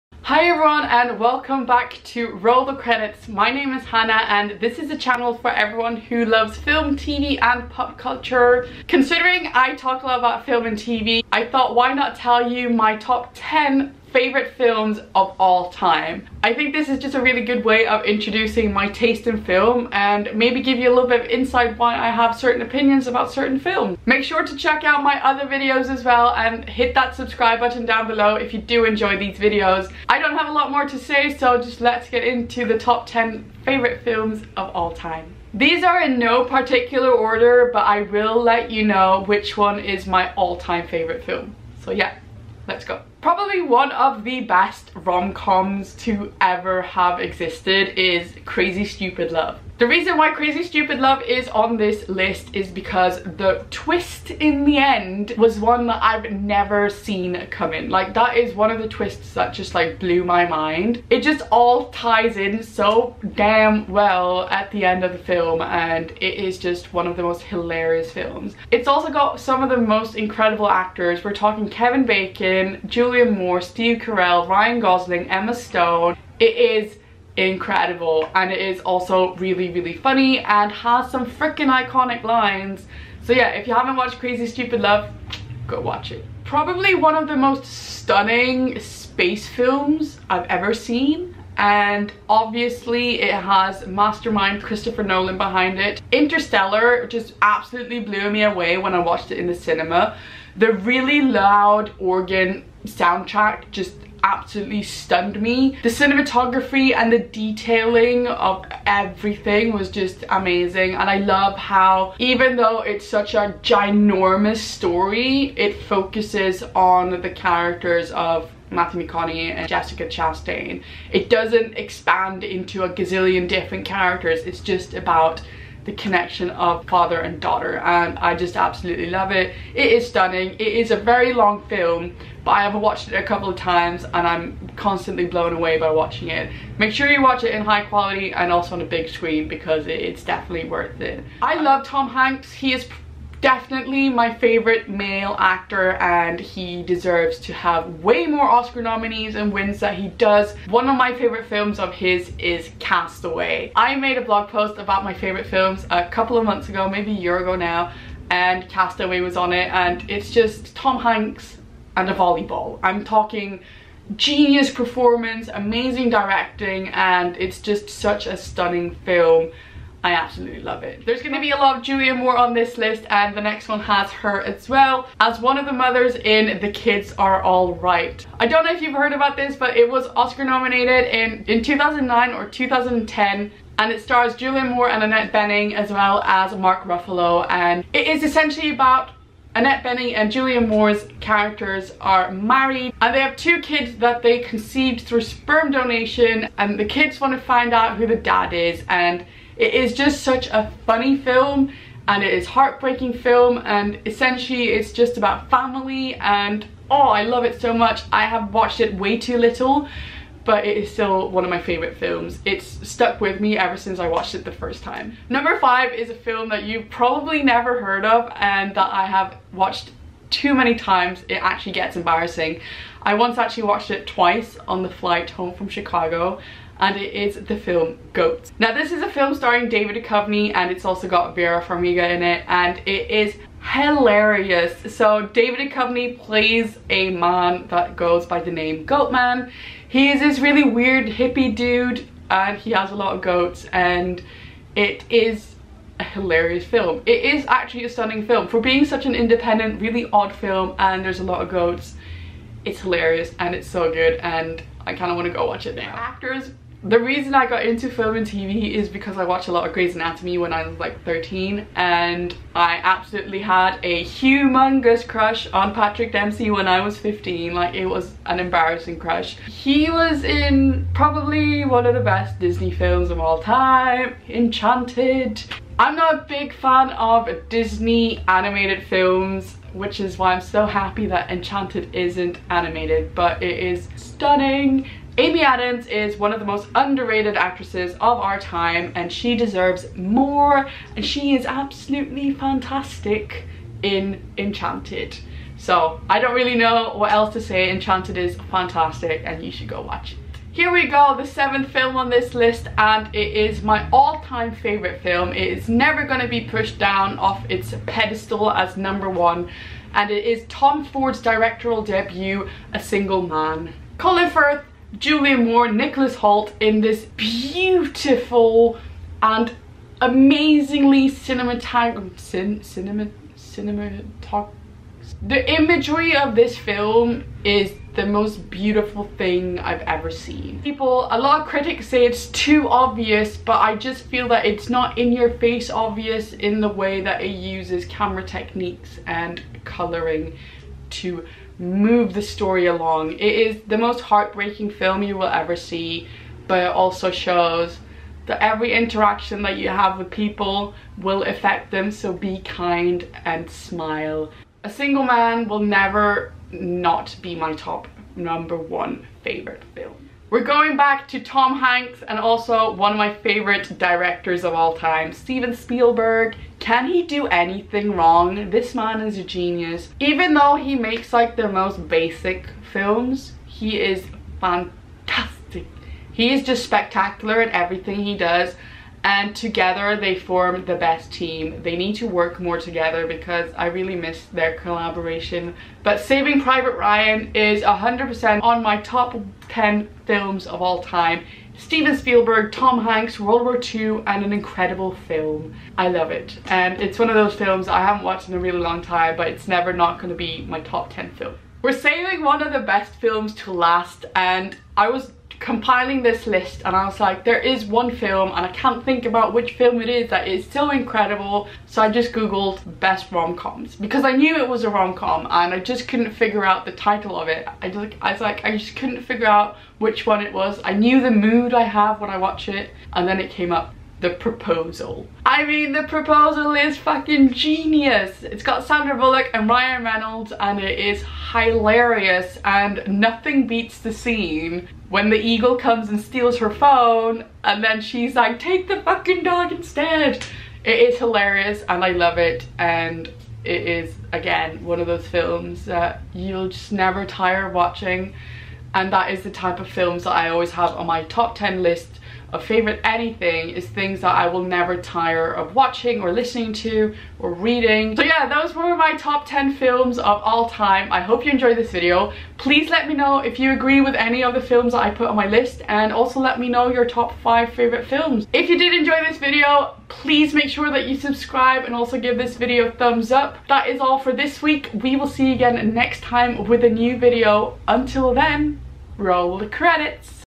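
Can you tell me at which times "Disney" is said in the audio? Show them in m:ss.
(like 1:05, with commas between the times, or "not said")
4:32, 4:37.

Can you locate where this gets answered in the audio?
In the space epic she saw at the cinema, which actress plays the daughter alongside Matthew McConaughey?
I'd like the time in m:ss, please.
1:59.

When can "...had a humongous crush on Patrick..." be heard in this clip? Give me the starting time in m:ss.
4:23.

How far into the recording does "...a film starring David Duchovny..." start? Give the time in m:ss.
3:49.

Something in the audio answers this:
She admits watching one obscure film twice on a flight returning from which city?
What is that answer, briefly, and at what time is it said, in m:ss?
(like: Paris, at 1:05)
Chicago, at 3:45.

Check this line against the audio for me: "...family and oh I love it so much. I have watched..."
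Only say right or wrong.
right.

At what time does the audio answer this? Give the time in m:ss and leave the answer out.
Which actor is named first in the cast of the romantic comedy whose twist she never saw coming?
1:11.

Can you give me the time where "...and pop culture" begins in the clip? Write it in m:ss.
0:07.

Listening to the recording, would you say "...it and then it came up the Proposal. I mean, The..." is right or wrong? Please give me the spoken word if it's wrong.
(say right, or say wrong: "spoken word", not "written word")
right.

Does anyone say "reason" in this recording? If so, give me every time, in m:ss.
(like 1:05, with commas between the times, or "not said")
0:49, 4:16.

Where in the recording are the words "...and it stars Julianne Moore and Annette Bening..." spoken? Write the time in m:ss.
3:03.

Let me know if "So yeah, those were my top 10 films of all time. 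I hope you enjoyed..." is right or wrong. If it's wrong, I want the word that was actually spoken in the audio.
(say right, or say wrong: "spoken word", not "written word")
right.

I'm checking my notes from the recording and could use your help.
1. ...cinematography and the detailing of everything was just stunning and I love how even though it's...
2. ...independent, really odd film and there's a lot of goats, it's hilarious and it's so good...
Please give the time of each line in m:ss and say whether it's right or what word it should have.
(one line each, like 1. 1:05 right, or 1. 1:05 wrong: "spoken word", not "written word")
1. 1:45 wrong: "amazing", not "stunning"
2. 4:09 right.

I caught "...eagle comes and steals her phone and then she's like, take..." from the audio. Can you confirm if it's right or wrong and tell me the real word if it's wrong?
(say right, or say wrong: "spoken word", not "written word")
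right.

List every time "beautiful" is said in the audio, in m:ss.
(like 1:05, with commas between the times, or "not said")
5:17, 5:28.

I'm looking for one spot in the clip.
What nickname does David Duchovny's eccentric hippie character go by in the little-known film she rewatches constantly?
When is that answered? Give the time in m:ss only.
3:58.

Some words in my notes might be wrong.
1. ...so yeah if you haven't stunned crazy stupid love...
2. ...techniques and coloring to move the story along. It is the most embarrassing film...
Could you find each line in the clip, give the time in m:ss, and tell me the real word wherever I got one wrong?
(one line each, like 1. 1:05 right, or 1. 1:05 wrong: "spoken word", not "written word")
1. 1:23 wrong: "watched", not "stunned"
2. 5:38 wrong: "heartbreaking", not "embarrassing".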